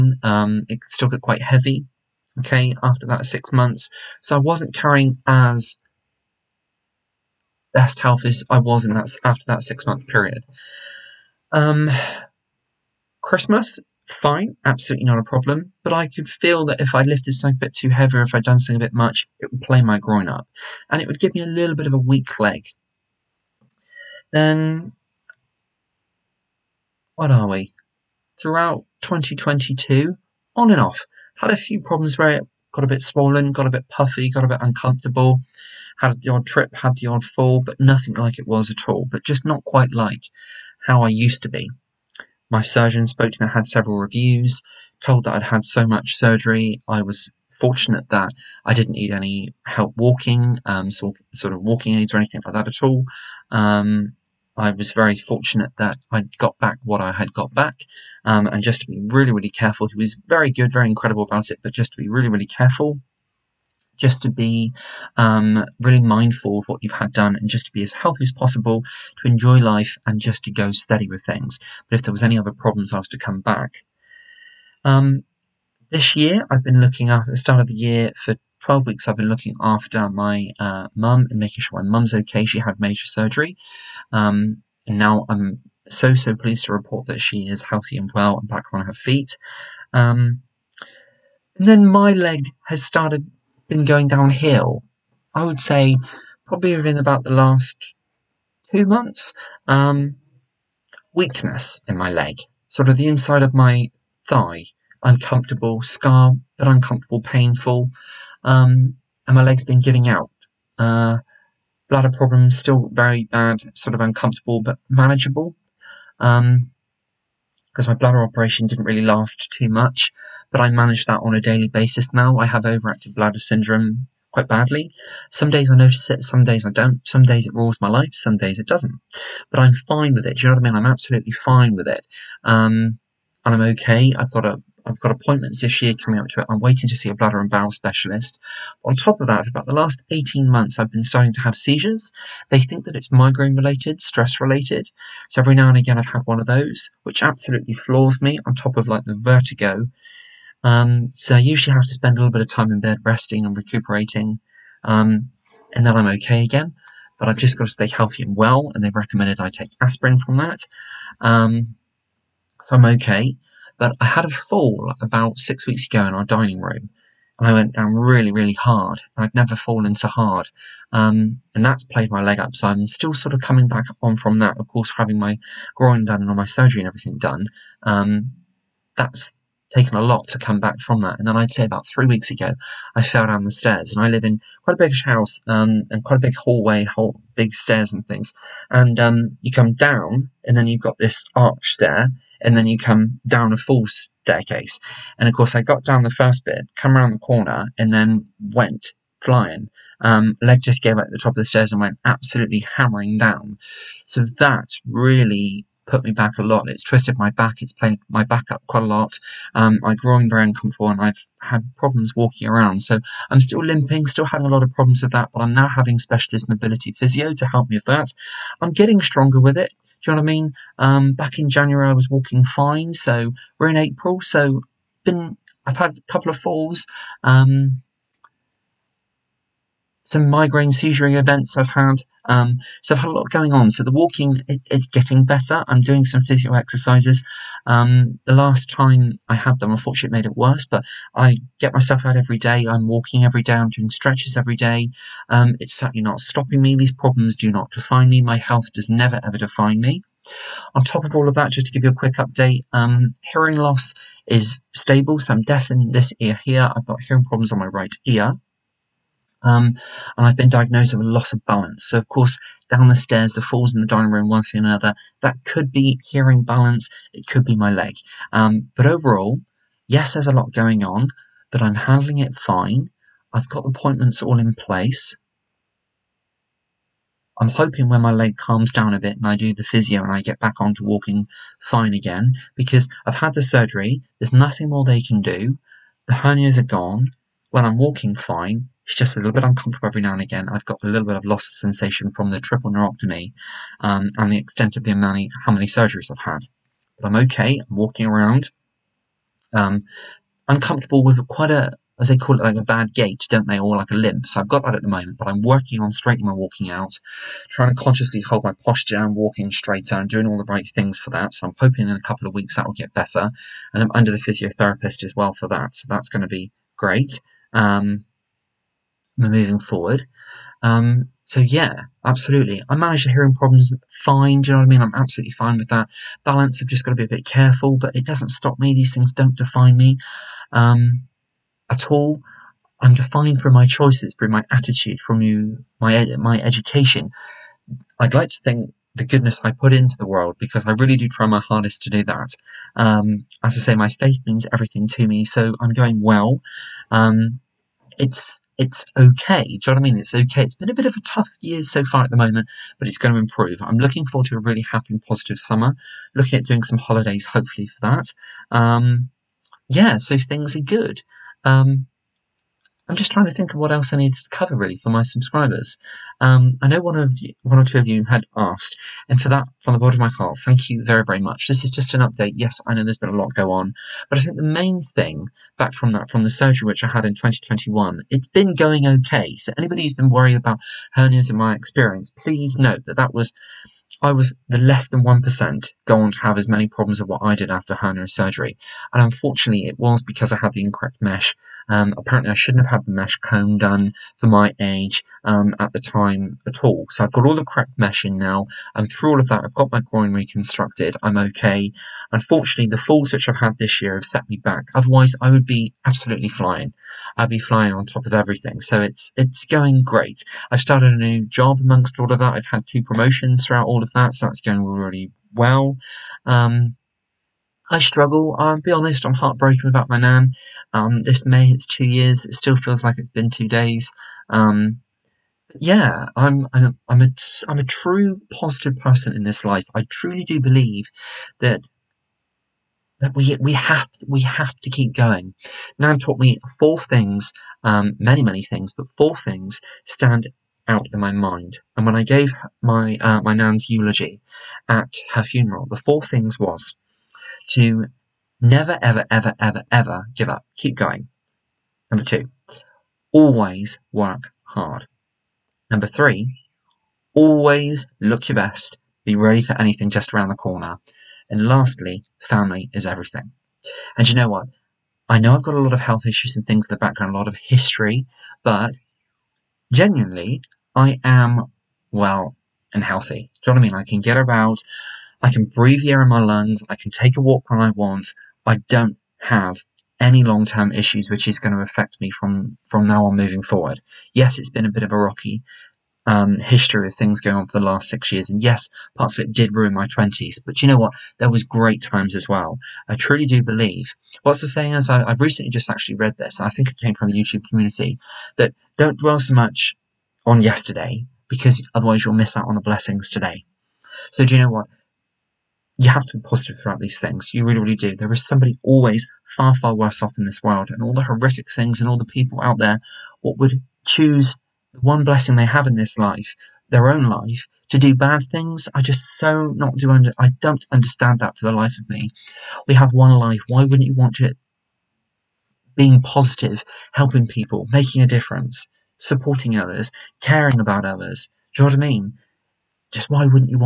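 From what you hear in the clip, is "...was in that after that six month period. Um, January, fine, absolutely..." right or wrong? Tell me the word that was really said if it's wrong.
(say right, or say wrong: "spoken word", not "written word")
wrong: "Christmas", not "January".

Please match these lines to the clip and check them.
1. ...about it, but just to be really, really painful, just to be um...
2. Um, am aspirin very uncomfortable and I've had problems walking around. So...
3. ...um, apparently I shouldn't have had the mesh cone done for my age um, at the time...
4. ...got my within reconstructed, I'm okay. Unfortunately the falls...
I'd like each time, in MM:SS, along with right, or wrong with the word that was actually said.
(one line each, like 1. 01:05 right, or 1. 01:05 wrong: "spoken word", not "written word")
1. 01:01 wrong: "careful", not "painful"
2. 03:29 wrong: "groin", not "aspirin"
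3. 06:31 right
4. 06:39 wrong: "groin", not "within".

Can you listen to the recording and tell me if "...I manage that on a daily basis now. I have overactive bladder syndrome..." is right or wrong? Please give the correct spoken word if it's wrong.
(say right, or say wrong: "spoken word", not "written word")
right.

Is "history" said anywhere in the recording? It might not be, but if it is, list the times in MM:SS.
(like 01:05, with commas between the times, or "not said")
07:47, 08:06.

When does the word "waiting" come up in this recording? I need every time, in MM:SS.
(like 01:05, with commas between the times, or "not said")
02:16.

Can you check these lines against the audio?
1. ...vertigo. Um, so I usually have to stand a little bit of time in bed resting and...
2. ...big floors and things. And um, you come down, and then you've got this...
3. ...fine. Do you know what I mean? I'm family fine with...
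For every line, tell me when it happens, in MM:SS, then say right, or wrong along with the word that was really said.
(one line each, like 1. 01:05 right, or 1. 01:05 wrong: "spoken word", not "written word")
1. 02:29 wrong: "spend", not "stand"
2. 03:07 wrong: "stairs", not "floors"
3. 05:23 wrong: "absolutely", not "family".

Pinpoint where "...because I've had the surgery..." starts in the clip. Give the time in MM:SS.
04:42.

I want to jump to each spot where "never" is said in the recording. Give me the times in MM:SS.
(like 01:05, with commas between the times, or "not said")
02:49, 04:08, 07:28.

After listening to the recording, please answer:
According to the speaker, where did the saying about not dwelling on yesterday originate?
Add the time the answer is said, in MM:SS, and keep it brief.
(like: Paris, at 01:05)
YouTube community, at 08:17.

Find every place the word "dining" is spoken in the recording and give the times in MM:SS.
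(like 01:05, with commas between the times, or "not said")
02:46, 04:23.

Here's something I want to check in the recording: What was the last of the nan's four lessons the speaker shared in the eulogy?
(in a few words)
Family is everything.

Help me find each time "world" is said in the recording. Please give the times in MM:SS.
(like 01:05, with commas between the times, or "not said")
05:40, 08:30.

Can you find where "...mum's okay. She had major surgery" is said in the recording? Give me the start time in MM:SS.
01:21.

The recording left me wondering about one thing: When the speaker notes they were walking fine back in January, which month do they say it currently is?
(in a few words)
April.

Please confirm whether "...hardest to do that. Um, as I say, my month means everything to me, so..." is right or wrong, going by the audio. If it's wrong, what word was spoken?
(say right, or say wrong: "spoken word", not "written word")
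wrong: "faith", not "month".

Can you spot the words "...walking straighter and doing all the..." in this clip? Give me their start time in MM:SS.
05:09.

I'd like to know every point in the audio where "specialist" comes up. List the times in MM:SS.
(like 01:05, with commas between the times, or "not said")
02:17, 03:35.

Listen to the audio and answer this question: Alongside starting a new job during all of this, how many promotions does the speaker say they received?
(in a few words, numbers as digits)
2.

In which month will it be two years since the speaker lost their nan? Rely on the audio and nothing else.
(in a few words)
May.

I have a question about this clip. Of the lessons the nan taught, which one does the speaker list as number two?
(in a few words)
Always work hard.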